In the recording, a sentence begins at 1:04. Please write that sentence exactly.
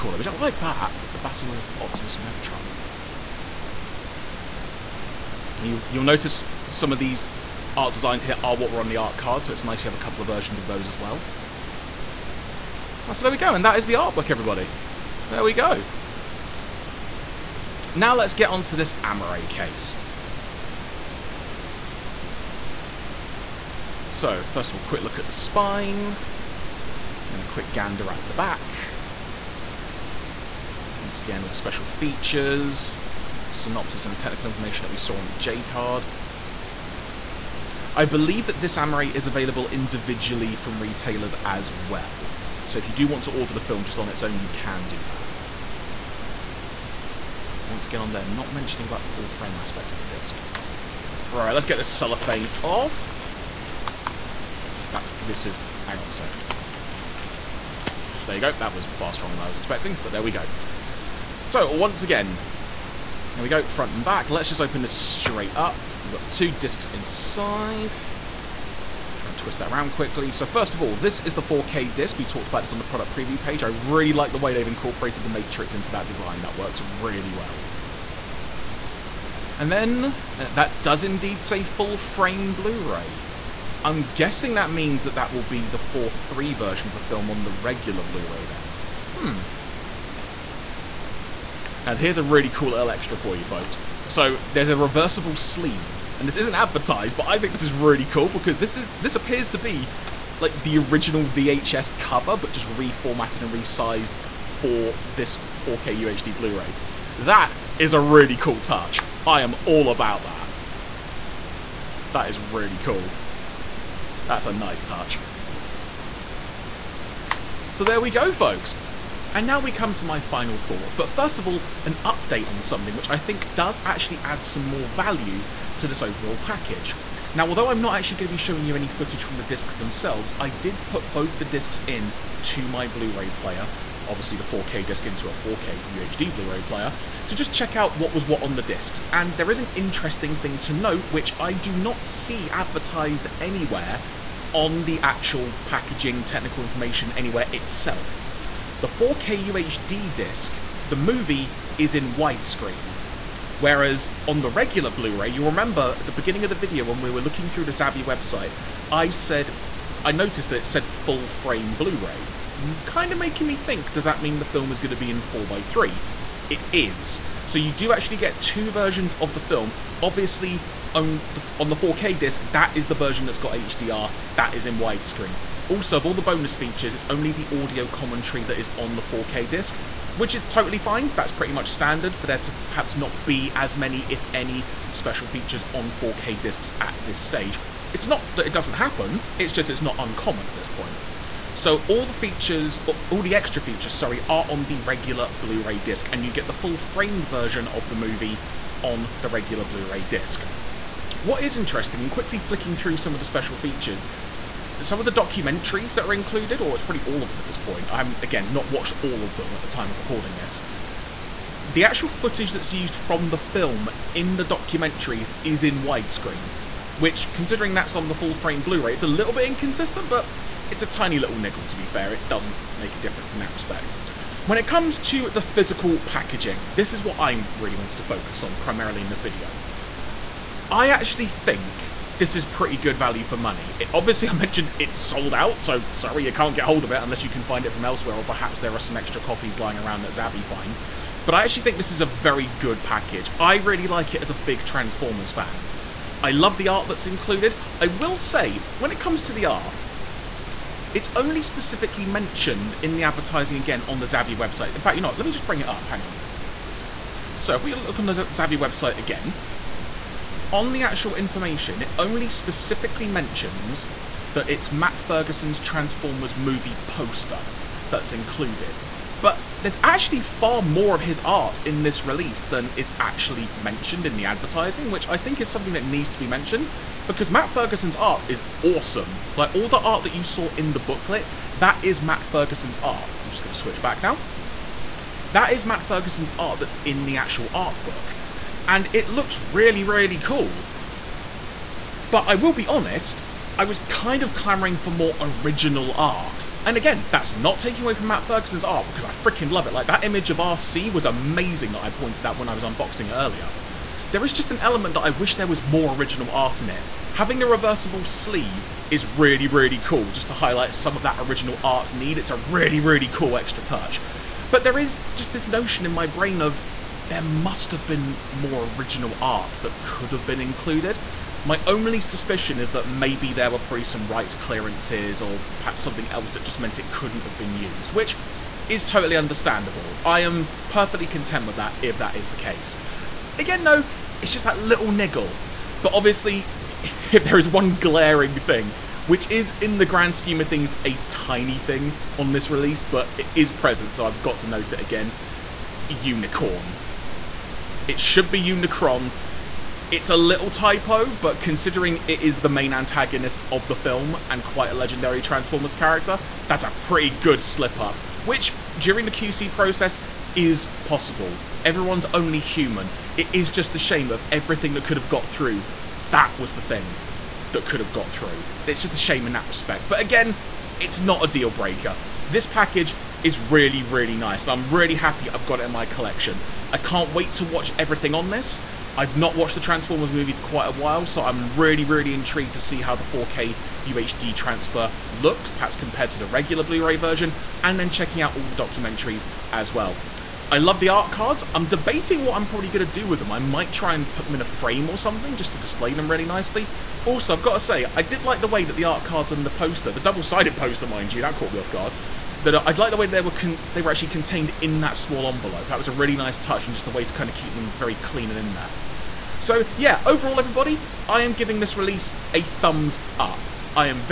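Let's just open this straight up.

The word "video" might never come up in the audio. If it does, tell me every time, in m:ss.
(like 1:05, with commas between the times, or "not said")
2:36, 3:49.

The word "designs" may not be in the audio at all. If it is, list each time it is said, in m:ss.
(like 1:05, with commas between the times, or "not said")
0:07, 1:16.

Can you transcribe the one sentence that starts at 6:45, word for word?
That was a really nice touch and just a way to kind of keep them very clean and in there.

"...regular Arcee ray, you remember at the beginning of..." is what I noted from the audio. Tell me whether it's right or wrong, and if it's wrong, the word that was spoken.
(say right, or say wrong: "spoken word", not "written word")
wrong: "Blu", not "Arcee".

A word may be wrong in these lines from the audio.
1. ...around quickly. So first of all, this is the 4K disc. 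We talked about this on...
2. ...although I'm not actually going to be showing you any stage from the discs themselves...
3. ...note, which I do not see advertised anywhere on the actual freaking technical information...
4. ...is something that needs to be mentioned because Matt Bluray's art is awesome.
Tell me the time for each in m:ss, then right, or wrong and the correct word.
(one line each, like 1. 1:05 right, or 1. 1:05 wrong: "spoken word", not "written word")
1. 1:09 right
2. 2:07 wrong: "footage", not "stage"
3. 2:20 wrong: "packaging", not "freaking"
4. 4:35 wrong: "Ferguson", not "Bluray".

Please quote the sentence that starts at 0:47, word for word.
Once again on there, not mentioning about the full frame aspect of the disc.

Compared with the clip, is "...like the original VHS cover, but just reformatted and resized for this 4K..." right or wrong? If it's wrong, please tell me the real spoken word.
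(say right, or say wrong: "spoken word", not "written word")
right.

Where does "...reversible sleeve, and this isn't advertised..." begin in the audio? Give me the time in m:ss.
1:34.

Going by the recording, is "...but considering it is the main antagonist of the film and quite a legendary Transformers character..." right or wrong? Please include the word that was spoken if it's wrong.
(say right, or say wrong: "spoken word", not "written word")
right.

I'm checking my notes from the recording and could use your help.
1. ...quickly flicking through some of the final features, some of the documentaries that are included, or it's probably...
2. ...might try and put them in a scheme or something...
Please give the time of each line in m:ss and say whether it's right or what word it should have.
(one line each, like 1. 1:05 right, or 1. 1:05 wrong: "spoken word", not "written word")
1. 3:22 wrong: "special", not "final"
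2. 6:33 wrong: "frame", not "scheme".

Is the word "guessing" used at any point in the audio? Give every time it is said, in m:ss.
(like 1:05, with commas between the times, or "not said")
1:24.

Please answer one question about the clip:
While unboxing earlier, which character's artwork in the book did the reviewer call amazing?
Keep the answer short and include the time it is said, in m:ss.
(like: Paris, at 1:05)
Arcee, at 5:00.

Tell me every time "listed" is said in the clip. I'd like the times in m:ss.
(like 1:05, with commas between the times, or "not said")
not said.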